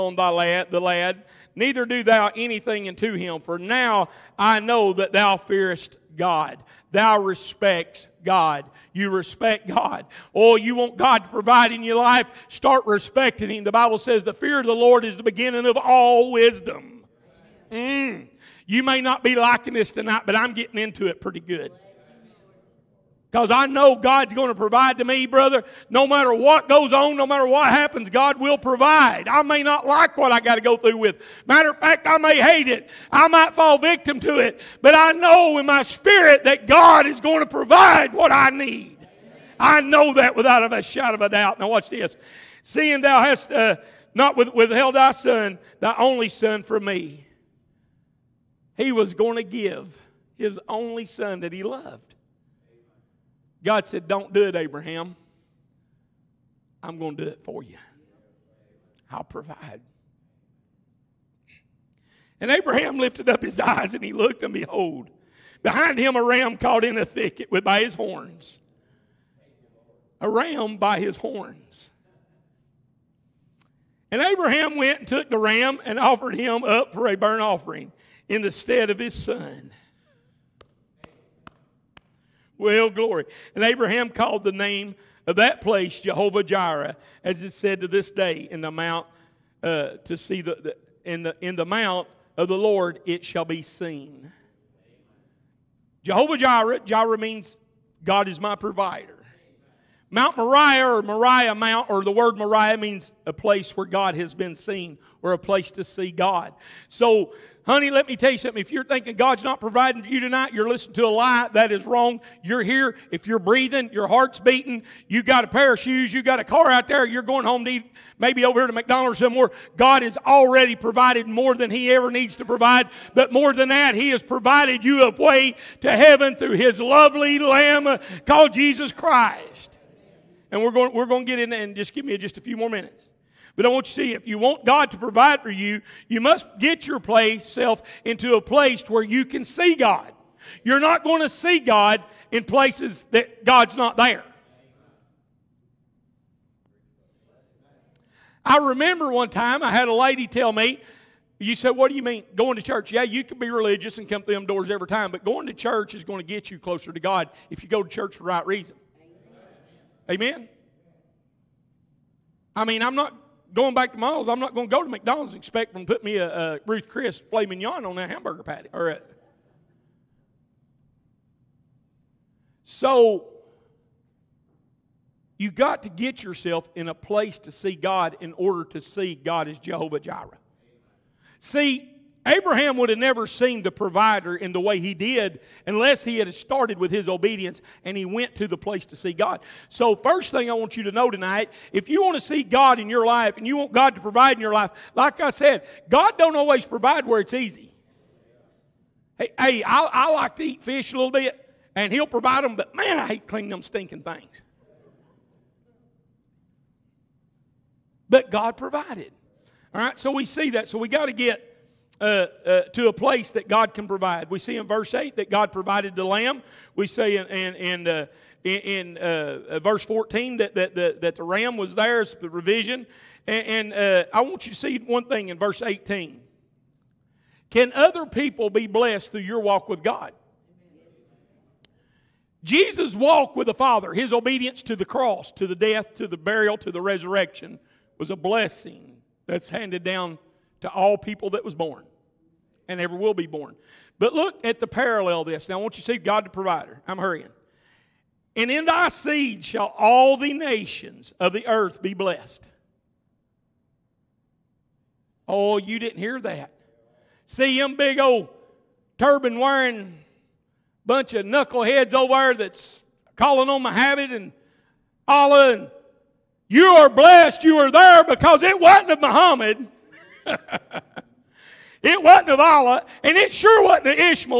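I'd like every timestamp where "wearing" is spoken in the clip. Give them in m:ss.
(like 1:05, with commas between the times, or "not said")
4:19.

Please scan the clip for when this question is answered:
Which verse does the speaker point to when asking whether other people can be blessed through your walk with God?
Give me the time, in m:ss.
3:45.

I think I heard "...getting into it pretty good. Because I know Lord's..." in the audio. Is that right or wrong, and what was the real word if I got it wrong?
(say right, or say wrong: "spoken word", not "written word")
wrong: "God", not "Lord".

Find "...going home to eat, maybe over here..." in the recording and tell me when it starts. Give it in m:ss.
1:57.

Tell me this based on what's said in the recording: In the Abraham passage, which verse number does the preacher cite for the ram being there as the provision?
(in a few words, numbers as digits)
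14.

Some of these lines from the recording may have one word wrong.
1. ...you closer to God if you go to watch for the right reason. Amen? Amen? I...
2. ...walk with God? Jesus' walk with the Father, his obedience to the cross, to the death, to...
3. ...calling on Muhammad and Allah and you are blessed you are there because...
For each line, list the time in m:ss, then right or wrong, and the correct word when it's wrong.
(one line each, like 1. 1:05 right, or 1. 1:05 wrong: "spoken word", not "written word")
1. 2:36 wrong: "church", not "watch"
2. 3:49 right
3. 4:23 right.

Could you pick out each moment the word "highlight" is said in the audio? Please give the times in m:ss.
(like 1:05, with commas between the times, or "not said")
not said.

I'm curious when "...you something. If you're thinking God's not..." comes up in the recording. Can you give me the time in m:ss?
1:48.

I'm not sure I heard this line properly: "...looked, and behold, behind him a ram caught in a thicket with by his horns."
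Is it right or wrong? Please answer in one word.
right.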